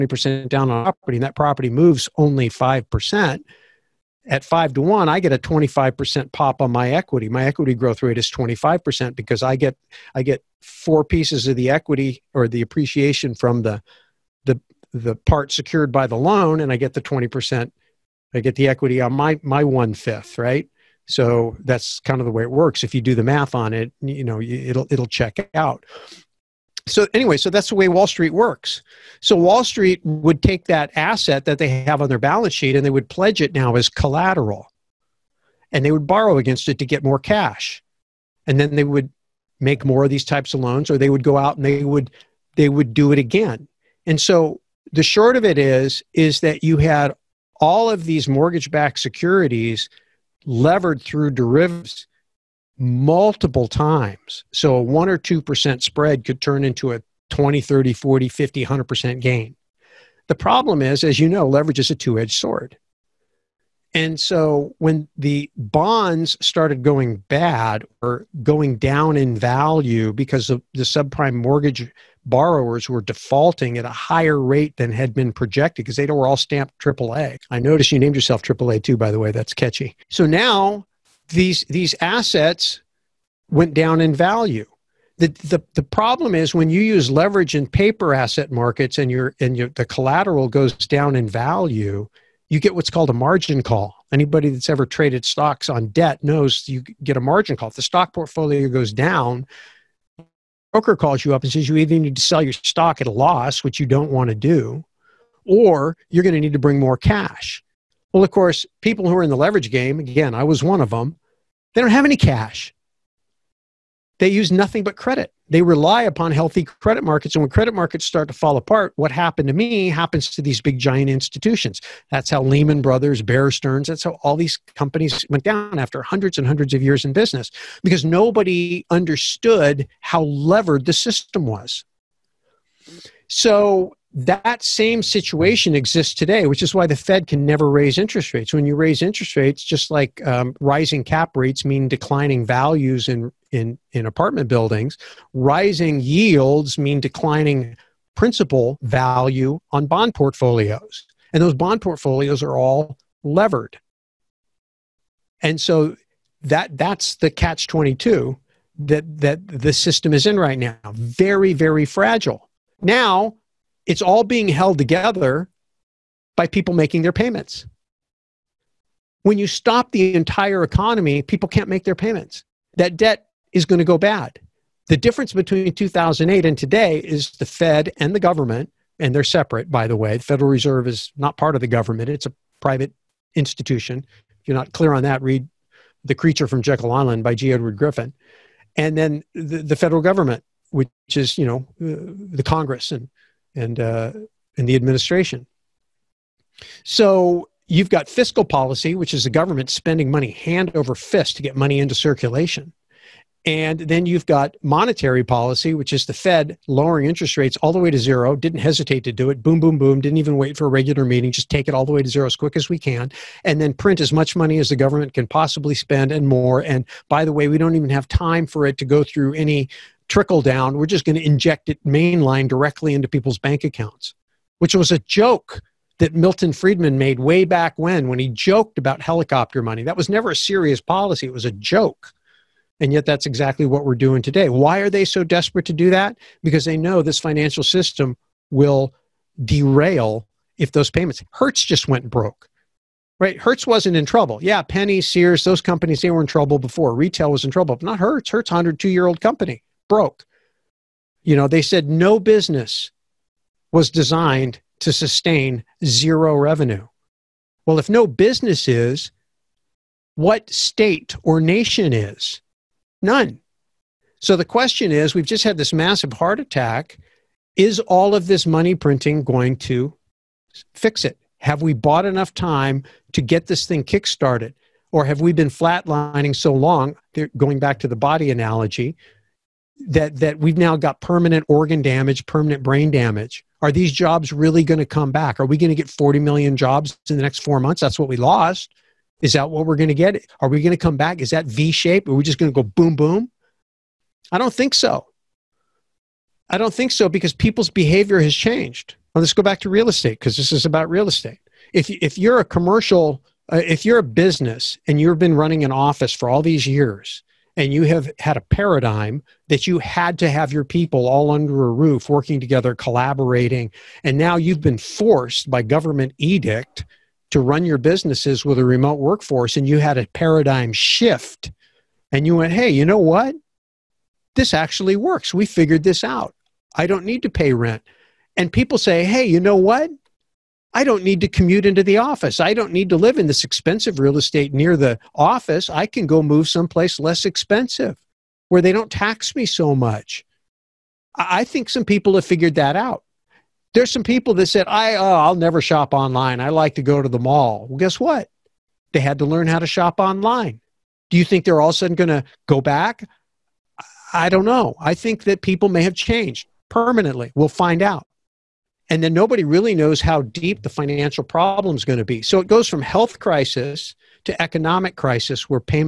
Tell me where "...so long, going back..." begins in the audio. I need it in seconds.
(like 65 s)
276 s.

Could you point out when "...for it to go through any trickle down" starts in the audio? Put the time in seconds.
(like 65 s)
218 s.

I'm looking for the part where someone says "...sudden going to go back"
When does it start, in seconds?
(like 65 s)
351 s.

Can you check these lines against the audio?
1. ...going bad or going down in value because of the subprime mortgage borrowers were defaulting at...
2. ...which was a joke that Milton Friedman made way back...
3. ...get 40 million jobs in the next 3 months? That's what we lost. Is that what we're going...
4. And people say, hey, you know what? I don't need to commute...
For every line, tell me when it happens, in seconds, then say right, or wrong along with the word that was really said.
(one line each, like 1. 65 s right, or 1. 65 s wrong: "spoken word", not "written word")
1. 66 s right
2. 224 s right
3. 285 s wrong: "4", not "3"
4. 328 s right.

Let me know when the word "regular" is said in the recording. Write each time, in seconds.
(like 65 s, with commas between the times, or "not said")
210 s.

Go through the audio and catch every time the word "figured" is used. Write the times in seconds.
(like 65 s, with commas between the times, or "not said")
325 s, 342 s.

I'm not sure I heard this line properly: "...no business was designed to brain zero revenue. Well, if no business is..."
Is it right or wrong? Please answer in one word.
wrong.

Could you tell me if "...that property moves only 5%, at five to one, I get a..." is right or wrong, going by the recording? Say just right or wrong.
right.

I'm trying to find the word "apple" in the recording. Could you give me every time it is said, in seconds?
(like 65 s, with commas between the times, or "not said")
not said.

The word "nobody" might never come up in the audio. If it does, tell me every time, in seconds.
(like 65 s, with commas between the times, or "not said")
128 s, 359 s.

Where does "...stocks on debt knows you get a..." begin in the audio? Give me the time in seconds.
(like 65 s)
95 s.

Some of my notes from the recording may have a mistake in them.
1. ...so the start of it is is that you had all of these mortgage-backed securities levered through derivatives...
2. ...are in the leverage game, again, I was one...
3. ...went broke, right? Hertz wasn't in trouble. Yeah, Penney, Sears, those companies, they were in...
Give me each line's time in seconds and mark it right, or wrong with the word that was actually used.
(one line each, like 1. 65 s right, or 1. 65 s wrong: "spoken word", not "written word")
1. 44 s wrong: "short", not "start"
2. 109 s right
3. 241 s right.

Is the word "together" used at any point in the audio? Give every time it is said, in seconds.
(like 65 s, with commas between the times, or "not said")
164 s, 312 s.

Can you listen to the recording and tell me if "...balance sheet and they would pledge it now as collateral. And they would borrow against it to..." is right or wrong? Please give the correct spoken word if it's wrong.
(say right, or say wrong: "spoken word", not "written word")
right.